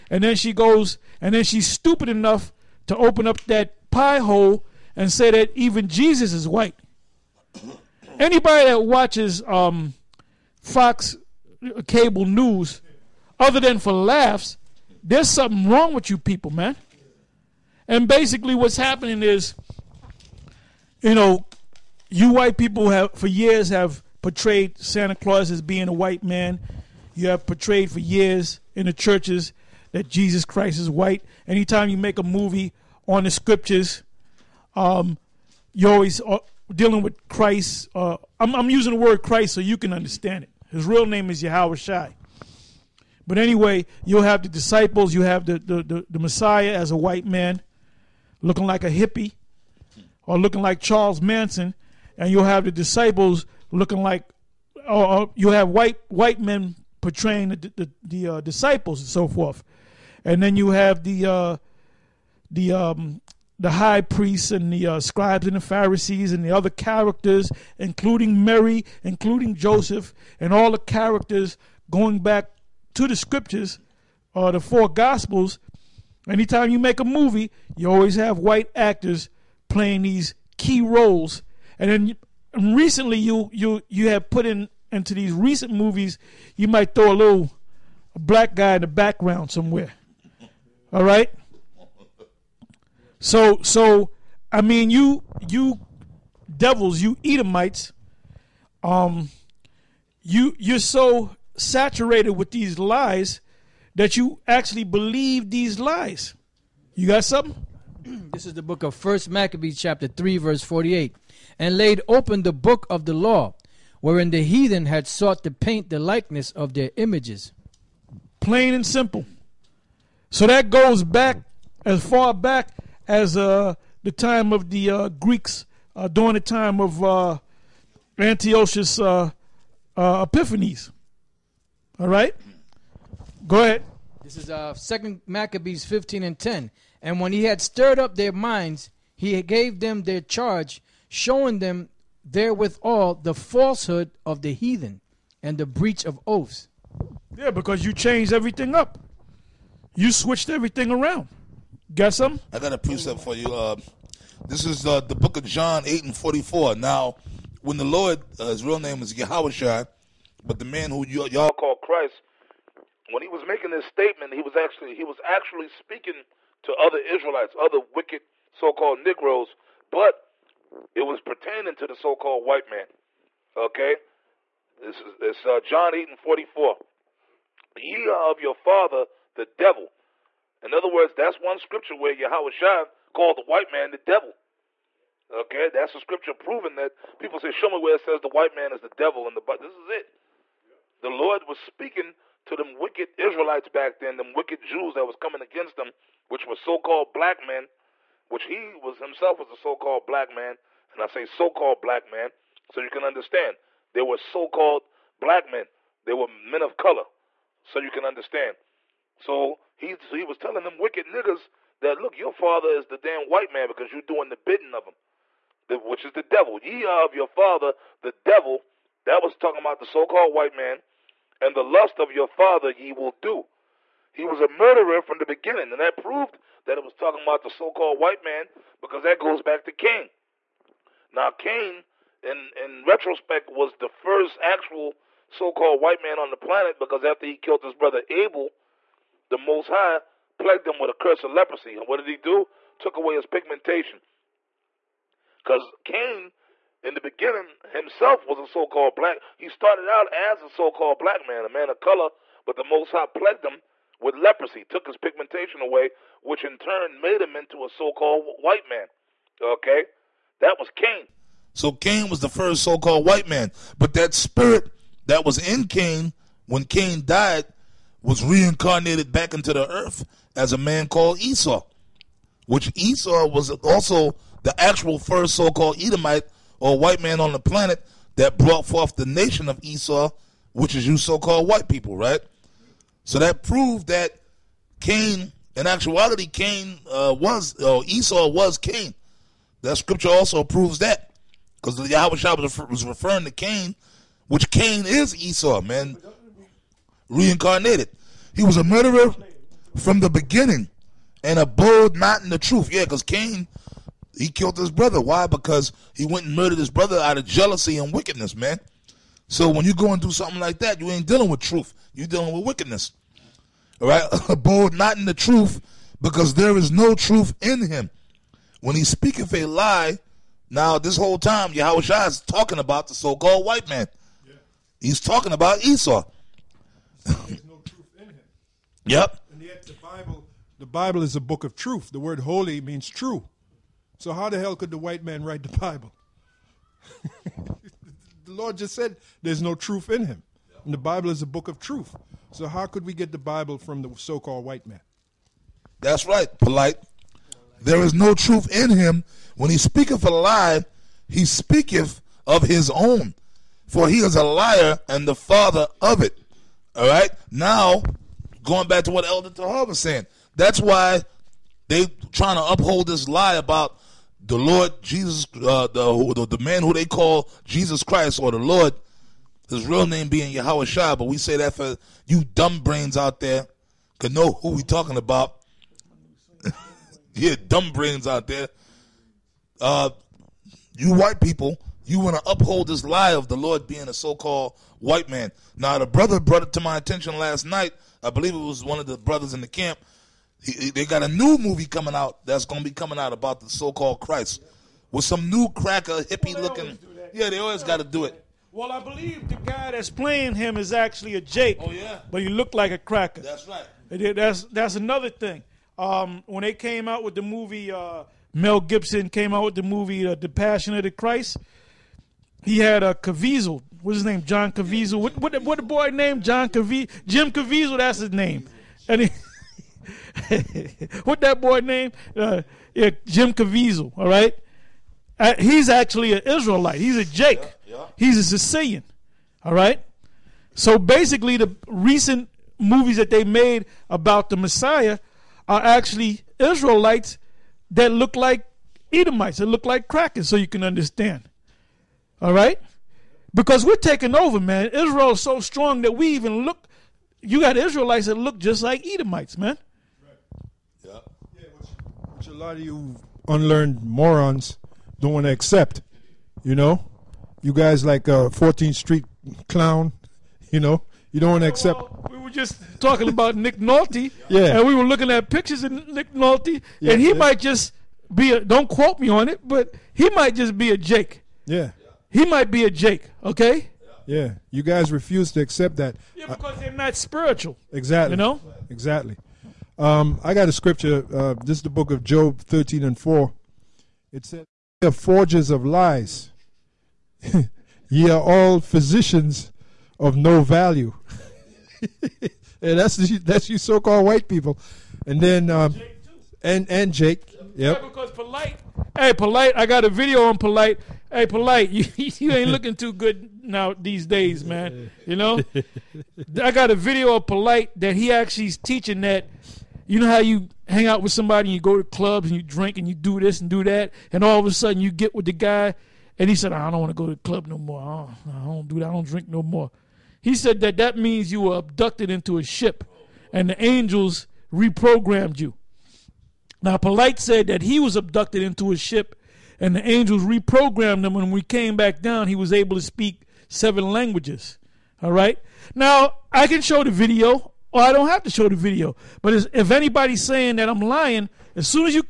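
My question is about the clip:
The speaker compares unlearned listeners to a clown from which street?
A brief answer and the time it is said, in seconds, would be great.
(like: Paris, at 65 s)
14th Street, at 458 s.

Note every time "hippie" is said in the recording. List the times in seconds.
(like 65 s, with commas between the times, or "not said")
48 s, 396 s.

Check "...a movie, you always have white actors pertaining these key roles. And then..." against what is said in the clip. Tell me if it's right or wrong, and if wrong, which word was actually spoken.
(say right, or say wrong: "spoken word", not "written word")
wrong: "playing", not "pertaining".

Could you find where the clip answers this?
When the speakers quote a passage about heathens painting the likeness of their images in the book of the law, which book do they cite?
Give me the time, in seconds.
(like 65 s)
108 s.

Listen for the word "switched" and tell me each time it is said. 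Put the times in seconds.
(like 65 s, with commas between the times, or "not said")
150 s.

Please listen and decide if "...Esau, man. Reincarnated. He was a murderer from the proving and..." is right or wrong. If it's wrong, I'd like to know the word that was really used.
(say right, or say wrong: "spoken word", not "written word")
wrong: "beginning", not "proving".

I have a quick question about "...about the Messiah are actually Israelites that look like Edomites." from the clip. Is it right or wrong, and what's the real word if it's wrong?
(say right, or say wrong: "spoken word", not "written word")
right.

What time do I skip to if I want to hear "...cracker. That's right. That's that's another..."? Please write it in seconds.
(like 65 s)
402 s.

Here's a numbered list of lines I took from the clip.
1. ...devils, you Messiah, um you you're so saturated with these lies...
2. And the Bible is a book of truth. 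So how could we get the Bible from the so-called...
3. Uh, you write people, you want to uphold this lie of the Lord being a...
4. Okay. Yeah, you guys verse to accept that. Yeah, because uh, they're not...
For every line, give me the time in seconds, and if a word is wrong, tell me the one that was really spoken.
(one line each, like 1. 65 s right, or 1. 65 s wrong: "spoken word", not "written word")
1. 96 s wrong: "Edomites", not "Messiah"
2. 340 s right
3. 379 s wrong: "white", not "write"
4. 473 s wrong: "refuse", not "verse".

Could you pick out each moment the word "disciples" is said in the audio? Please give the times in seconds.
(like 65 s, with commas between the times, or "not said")
44 s, 52 s, 58 s.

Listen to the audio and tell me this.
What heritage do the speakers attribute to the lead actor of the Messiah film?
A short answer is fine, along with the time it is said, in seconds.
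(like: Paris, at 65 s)
Sicilian, at 428 s.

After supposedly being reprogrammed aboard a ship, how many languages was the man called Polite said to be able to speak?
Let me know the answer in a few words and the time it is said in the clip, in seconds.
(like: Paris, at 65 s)
7, at 533 s.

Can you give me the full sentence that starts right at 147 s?
Yeah, because you changed everything up.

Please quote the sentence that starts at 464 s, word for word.
And we were looking at pictures of Nick Nolte, yeah, and he yeah.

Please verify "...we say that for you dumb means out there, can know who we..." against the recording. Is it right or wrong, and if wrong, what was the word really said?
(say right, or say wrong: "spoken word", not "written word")
wrong: "brains", not "means".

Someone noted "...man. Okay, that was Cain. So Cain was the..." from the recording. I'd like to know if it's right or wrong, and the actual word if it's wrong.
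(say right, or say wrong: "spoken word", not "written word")
right.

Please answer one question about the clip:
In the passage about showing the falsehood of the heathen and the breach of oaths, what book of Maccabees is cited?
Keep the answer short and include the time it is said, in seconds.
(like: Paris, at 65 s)
Second Maccabees, at 134 s.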